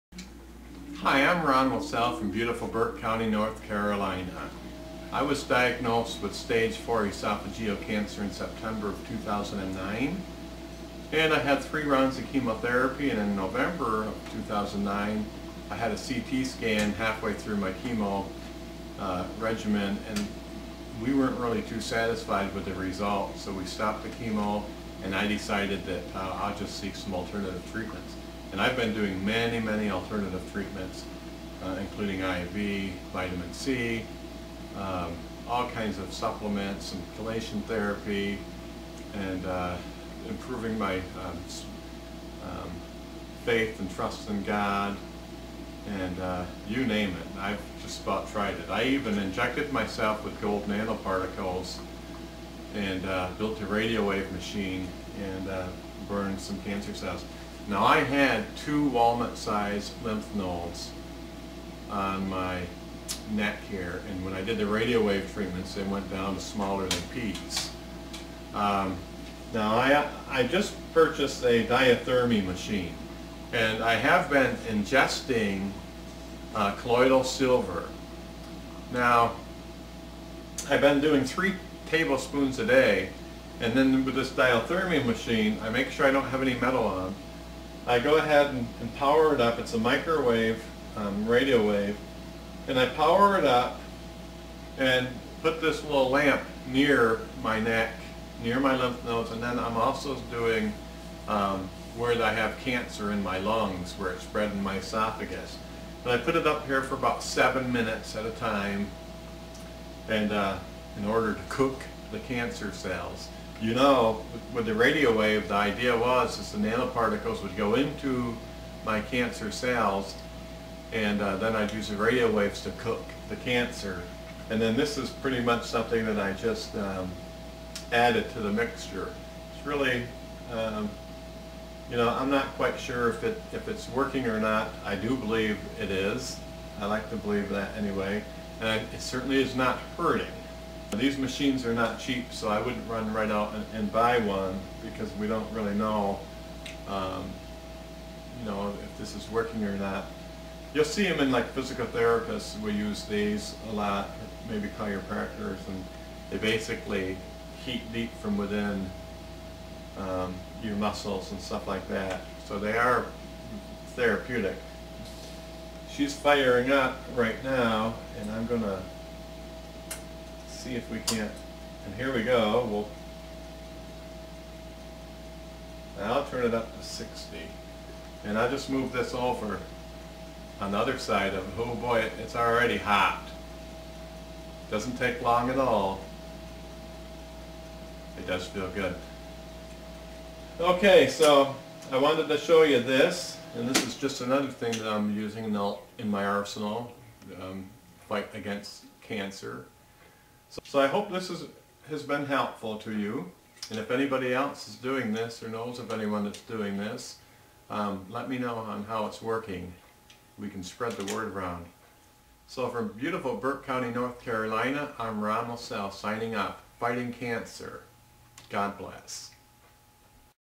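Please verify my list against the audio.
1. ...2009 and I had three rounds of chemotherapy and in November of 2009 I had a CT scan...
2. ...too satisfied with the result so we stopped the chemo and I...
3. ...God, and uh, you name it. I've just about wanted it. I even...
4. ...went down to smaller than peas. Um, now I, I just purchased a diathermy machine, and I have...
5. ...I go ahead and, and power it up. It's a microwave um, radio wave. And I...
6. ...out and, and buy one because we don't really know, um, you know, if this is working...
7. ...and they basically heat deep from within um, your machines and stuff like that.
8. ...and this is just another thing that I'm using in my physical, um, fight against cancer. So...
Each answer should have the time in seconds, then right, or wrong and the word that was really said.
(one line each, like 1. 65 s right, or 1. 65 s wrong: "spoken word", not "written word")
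1. 9 s right
2. 21 s right
3. 44 s wrong: "tried", not "wanted"
4. 65 s right
5. 87 s right
6. 143 s right
7. 155 s wrong: "muscles", not "machines"
8. 193 s wrong: "arsenal", not "physical".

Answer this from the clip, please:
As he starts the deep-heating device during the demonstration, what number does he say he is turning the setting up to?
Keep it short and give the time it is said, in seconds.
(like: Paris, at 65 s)
60, at 176 s.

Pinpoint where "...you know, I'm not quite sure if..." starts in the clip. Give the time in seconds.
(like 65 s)
131 s.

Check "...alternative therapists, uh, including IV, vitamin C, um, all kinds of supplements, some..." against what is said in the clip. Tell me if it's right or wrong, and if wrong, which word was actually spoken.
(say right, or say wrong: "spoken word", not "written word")
wrong: "treatments", not "therapists".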